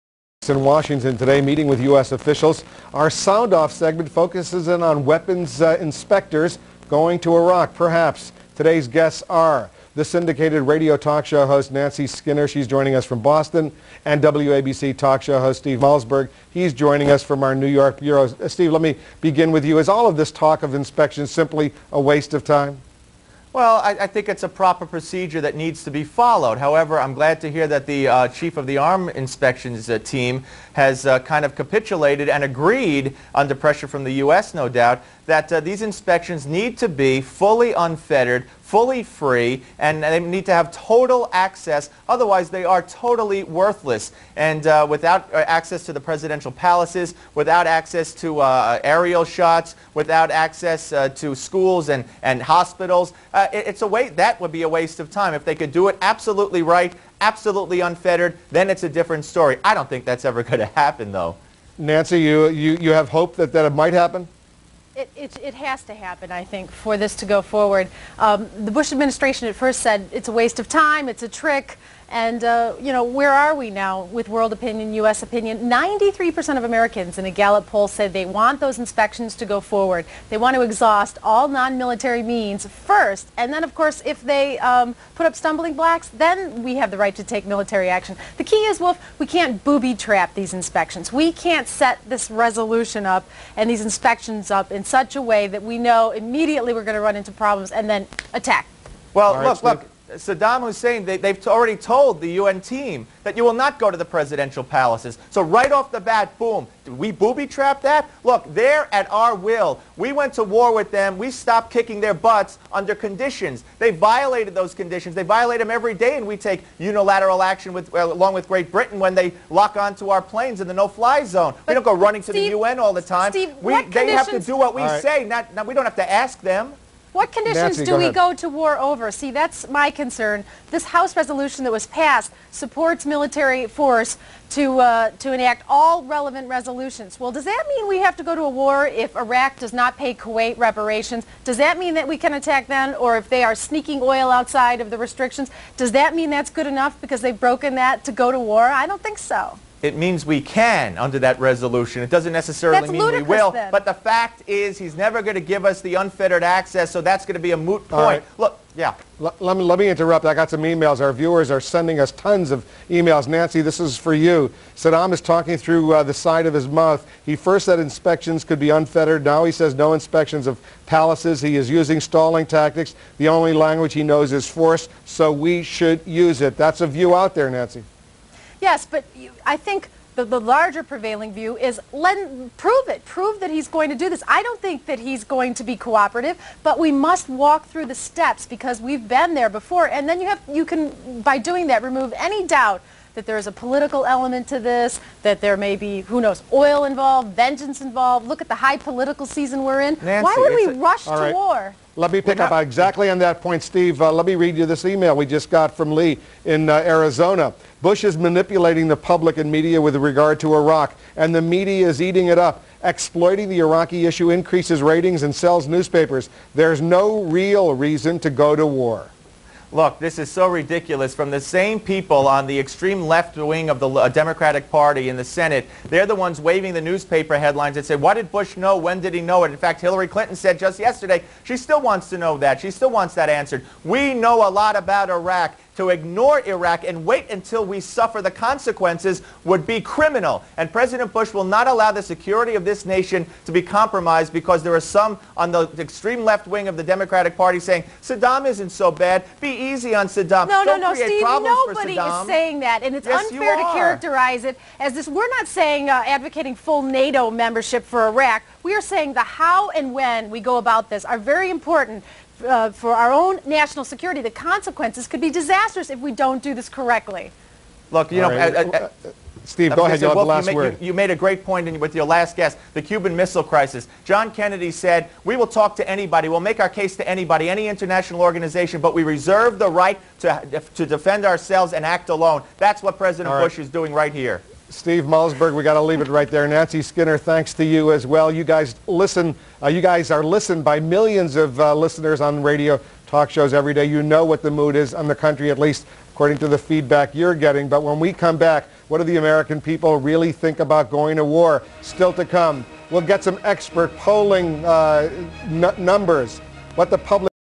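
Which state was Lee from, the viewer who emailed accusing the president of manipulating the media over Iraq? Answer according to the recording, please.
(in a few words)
Arizona.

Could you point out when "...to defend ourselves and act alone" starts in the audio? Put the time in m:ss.
4:40.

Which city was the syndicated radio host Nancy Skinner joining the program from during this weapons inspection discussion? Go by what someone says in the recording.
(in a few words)
Boston.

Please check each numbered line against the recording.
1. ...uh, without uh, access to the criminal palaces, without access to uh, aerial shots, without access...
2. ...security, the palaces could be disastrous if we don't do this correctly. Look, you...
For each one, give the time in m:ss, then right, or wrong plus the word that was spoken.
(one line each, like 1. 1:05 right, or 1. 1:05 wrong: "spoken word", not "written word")
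1. 0:44 wrong: "presidential", not "criminal"
2. 4:23 wrong: "consequences", not "palaces".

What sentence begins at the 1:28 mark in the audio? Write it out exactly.
The key is, Wolf, we can't booby trap these inspections.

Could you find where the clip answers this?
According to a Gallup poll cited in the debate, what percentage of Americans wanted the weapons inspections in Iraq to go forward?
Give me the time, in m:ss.
1:15.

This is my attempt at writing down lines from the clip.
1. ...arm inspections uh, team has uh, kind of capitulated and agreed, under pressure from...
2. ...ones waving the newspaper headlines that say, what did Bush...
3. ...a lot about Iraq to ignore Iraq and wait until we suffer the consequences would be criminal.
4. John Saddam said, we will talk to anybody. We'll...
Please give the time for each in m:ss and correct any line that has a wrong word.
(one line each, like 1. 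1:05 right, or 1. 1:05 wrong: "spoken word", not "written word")
1. 0:28 right
2. 3:46 right
3. 3:54 right
4. 4:34 wrong: "Kennedy", not "Saddam".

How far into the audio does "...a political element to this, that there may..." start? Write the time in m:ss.
3:13.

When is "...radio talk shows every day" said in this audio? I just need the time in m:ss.
4:52.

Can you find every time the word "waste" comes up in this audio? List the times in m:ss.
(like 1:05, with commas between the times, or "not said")
0:22, 0:54, 1:10.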